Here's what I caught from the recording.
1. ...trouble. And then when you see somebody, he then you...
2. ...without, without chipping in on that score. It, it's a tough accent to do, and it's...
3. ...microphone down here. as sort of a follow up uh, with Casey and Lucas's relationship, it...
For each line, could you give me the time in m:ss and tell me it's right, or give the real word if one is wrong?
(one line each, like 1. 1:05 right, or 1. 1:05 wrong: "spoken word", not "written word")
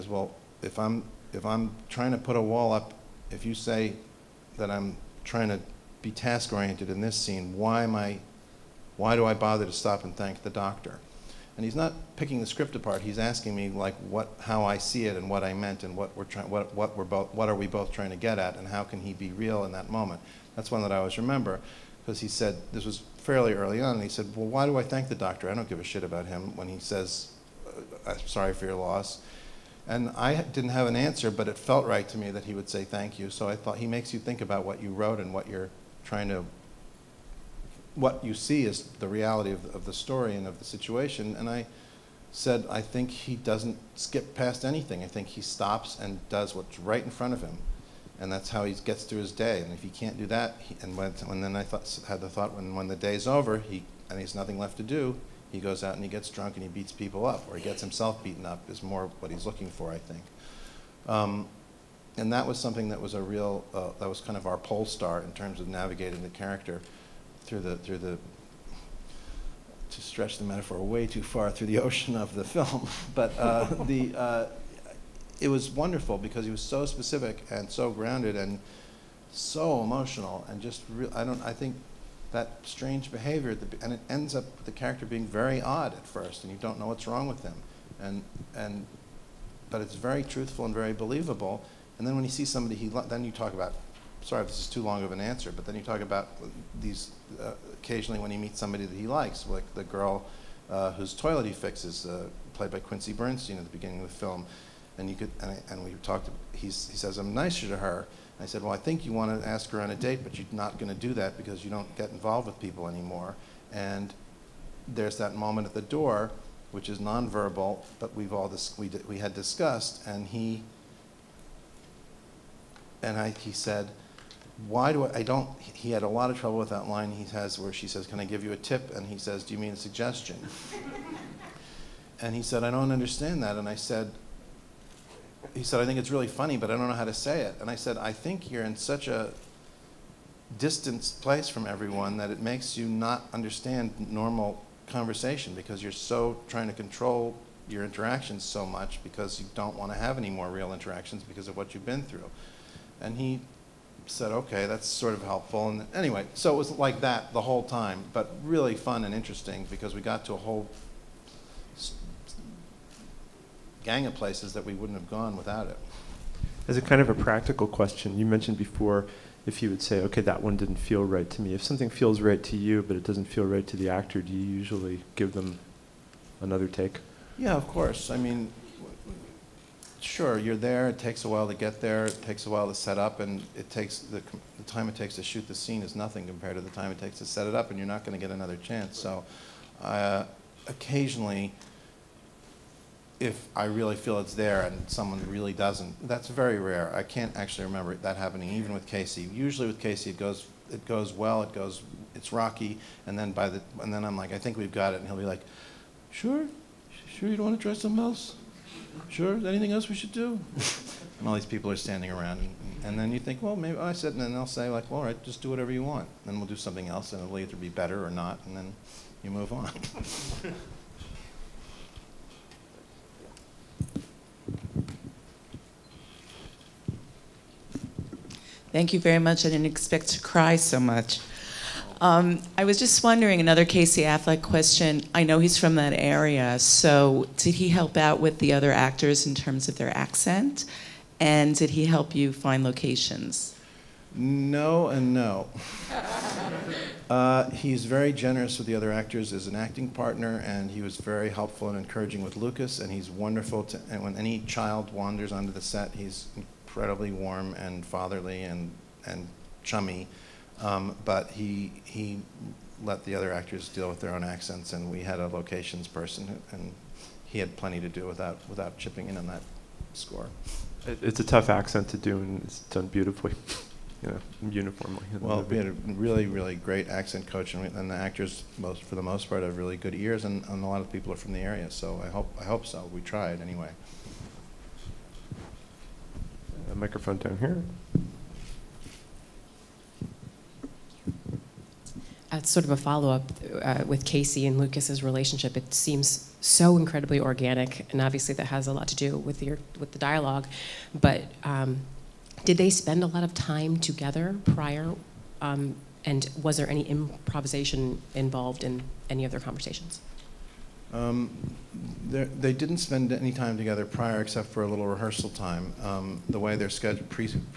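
1. 1:30 wrong: "believable", not "trouble"
2. 4:28 right
3. 4:46 right.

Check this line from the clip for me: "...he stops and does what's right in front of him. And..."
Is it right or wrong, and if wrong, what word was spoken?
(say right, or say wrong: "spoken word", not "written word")
right.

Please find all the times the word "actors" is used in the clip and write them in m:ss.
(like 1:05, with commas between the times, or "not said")
2:53, 3:58, 4:08, 4:23, 4:37.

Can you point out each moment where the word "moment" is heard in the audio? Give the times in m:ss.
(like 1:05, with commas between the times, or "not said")
0:19, 1:55.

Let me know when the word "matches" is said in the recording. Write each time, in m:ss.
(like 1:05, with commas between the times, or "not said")
not said.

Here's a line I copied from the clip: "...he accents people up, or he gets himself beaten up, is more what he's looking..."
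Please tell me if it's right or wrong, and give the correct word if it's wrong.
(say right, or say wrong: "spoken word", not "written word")
wrong: "beats", not "accents".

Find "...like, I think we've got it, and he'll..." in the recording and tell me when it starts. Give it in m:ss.
3:24.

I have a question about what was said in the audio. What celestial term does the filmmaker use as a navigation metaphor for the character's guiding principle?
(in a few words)
Pole star.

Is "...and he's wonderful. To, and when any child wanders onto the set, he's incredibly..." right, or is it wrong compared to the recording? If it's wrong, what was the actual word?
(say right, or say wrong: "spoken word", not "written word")
right.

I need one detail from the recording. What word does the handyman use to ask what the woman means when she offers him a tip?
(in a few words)
Suggestion.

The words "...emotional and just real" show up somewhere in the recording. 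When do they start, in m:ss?
1:19.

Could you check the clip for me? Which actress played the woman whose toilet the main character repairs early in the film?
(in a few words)
Quincy Bernstein.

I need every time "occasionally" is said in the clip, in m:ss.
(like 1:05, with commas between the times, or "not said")
1:37, 3:10.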